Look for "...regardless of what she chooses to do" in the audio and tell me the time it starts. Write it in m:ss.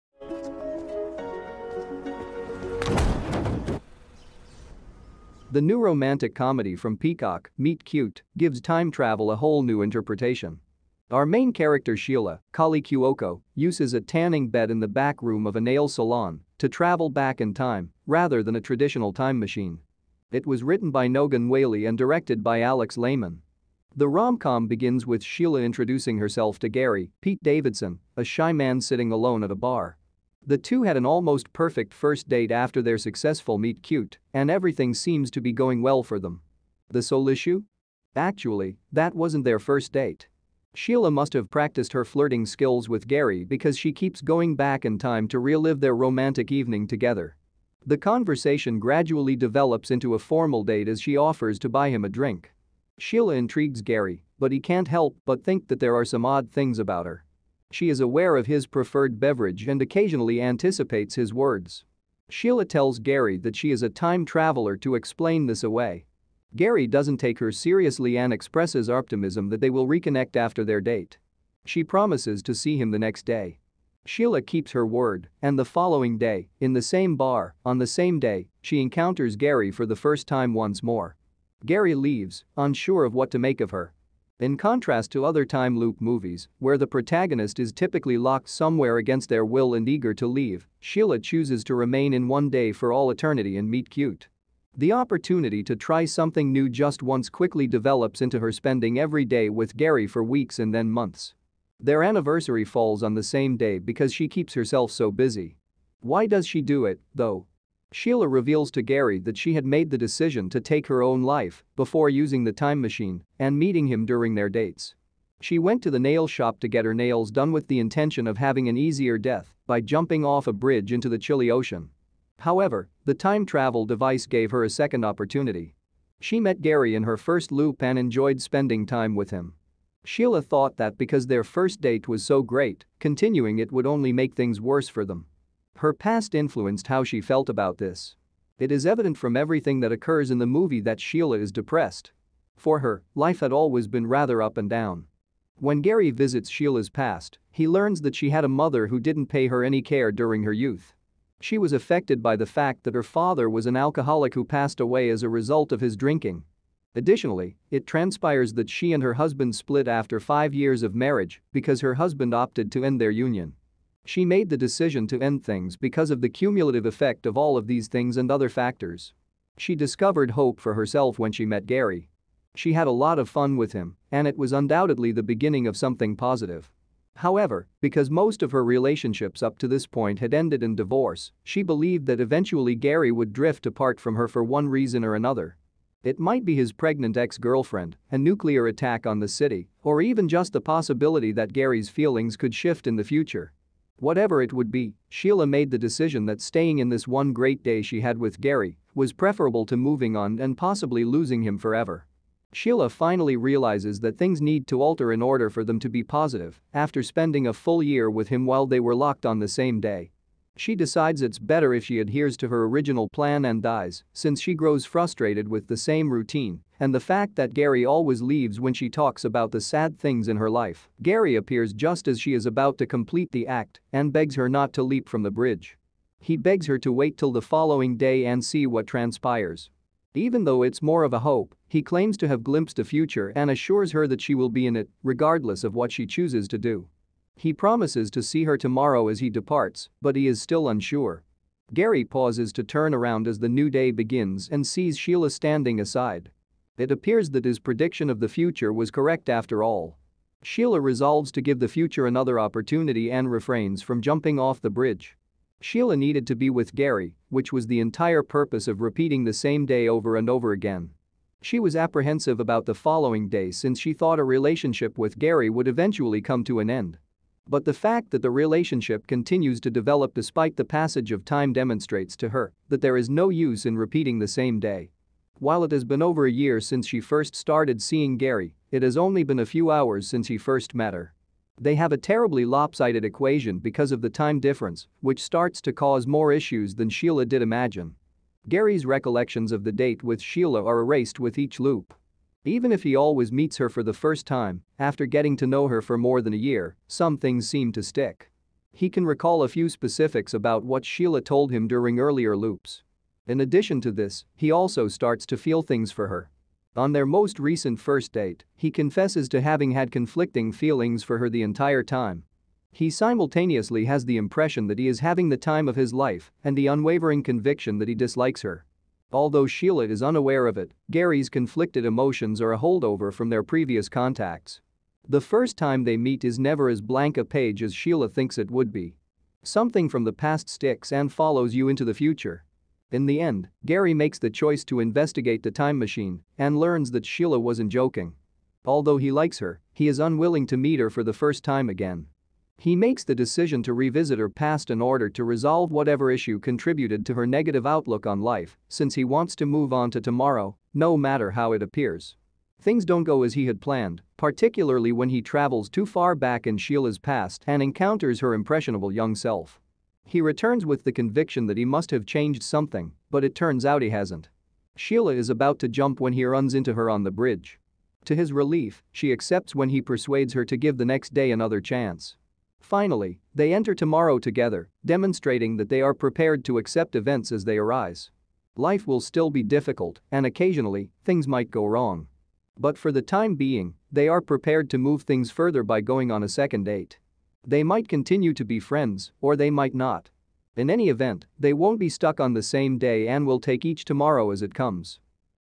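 3:55.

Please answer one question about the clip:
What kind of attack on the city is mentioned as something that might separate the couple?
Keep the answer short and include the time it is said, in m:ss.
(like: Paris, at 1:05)
nuclear attack, at 3:08.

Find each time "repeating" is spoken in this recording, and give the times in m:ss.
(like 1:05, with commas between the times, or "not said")
4:18, 4:33.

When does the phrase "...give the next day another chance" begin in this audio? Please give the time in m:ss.
6:10.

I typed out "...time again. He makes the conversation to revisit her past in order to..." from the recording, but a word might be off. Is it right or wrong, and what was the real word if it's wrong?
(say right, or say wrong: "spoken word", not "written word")
wrong: "decision", not "conversation".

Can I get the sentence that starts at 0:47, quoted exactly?
The conversation gradually develops into a formal date as she offers to buy him a drink.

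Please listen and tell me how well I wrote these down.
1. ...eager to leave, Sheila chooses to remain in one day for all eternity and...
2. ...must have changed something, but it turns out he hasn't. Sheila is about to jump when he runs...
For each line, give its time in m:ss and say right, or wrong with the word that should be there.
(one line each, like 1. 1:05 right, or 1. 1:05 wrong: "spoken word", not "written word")
1. 1:29 right
2. 6:01 right.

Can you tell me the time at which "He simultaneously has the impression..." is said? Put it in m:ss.
5:12.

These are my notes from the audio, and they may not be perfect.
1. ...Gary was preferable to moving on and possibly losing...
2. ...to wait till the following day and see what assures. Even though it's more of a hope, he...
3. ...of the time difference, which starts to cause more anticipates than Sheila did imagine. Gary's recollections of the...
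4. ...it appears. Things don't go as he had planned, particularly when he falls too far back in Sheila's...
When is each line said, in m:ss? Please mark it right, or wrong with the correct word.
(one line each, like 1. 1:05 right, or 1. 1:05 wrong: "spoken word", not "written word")
1. 3:18 right
2. 3:46 wrong: "transpires", not "assures"
3. 4:43 wrong: "issues", not "anticipates"
4. 5:51 wrong: "travels", not "falls".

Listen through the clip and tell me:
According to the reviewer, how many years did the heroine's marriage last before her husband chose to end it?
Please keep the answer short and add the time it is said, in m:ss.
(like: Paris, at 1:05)
5, at 2:40.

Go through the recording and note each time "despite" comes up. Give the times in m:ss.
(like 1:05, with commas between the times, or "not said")
4:30.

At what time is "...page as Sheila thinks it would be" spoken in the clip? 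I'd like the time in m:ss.
5:27.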